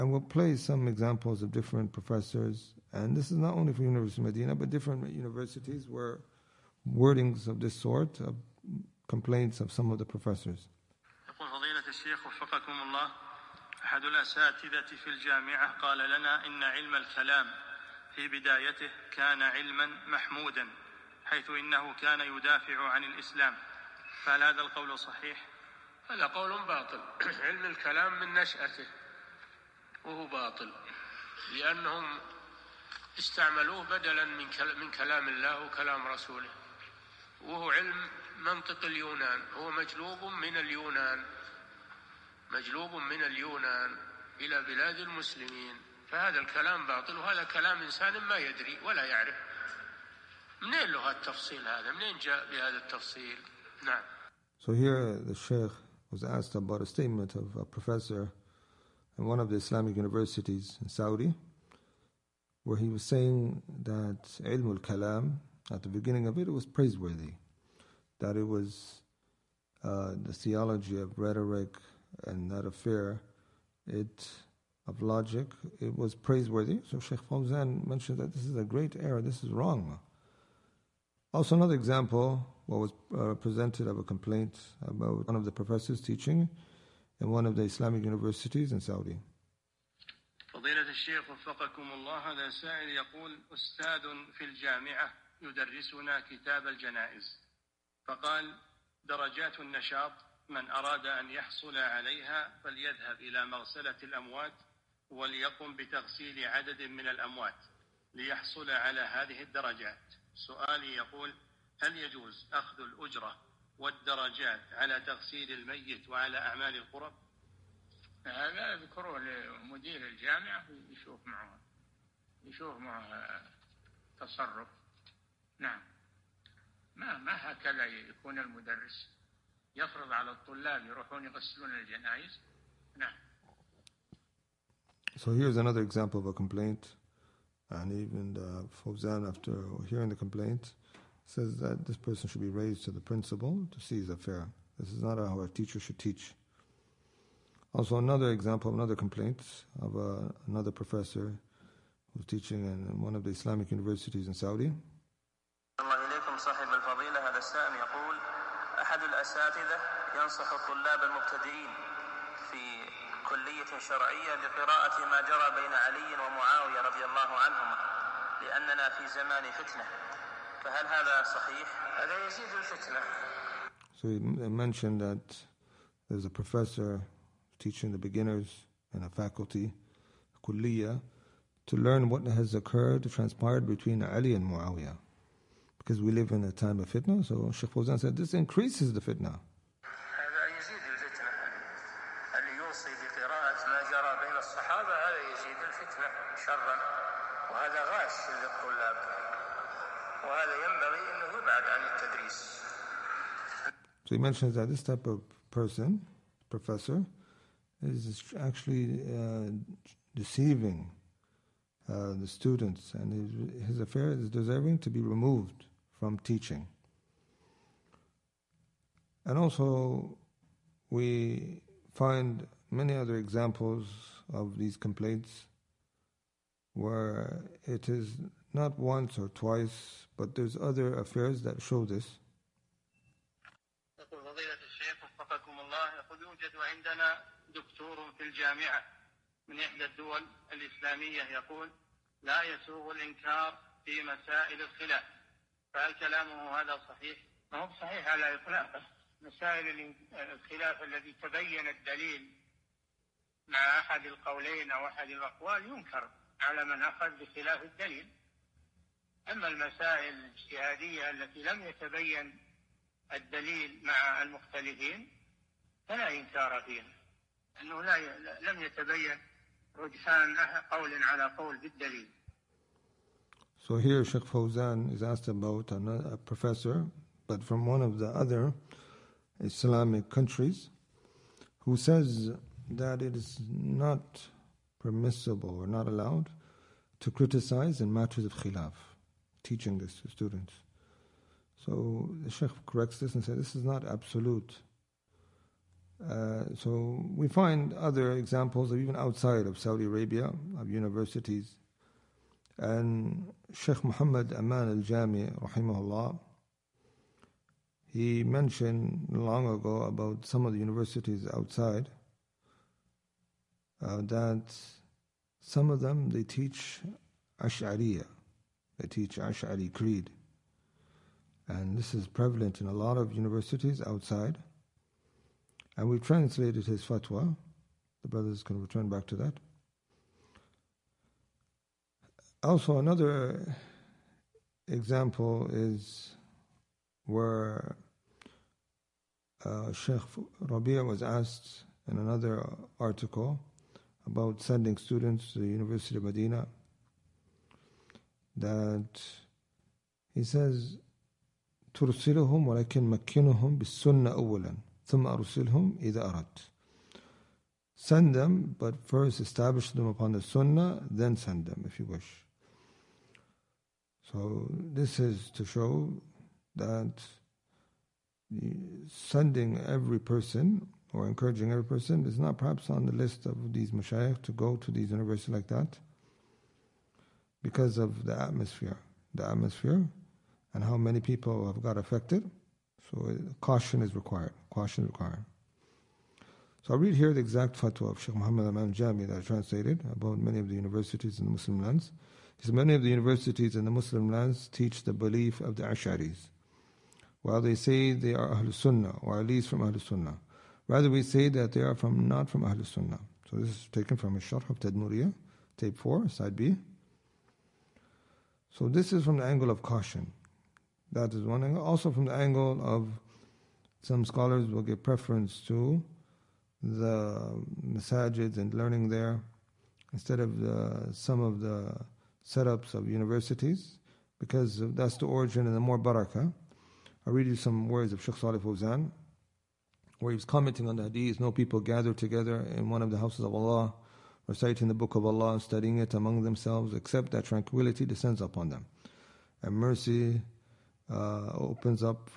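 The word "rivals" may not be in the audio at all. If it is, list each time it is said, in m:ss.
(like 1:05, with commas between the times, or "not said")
not said.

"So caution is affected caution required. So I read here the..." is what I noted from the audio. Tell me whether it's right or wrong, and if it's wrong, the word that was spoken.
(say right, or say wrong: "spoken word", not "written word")
wrong: "required", not "affected".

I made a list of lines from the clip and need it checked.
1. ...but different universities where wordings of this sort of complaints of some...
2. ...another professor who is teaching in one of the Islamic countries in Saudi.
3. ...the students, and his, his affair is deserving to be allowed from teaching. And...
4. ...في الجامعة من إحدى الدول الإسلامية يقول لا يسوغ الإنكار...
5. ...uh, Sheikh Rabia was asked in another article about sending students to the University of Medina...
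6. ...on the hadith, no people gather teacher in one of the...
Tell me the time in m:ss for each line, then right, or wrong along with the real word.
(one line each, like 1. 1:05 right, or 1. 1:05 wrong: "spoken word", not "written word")
1. 0:04 right
2. 2:30 wrong: "universities", not "countries"
3. 3:32 wrong: "removed", not "allowed"
4. 3:58 right
5. 5:39 right
6. 7:10 wrong: "together", not "teacher".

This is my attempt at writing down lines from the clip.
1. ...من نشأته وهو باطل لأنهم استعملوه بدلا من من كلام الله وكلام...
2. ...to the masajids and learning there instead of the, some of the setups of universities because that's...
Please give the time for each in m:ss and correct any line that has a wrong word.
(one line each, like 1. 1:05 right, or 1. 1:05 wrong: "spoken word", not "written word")
1. 0:28 right
2. 6:55 right.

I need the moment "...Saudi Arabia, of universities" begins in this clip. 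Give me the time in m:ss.
4:59.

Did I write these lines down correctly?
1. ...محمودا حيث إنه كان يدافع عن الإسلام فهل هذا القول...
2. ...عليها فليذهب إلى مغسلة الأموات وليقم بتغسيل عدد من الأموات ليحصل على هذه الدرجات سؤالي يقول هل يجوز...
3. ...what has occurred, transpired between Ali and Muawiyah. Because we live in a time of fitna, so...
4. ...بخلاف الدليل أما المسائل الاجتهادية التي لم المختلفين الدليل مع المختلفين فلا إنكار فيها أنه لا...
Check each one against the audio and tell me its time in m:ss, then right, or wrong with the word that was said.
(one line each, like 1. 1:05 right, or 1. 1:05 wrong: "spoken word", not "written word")
1. 0:20 right
2. 1:41 right
3. 3:02 right
4. 4:17 wrong: "يتبين", not "المختلفين".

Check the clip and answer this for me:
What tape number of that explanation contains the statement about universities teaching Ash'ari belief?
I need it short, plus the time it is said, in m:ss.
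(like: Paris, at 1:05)
4, at 6:45.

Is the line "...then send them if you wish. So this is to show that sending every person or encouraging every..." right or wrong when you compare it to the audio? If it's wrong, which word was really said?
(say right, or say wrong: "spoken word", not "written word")
right.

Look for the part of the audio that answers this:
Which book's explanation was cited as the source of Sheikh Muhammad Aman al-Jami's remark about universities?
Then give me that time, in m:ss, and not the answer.
6:44.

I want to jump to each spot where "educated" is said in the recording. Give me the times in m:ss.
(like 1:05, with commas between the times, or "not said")
not said.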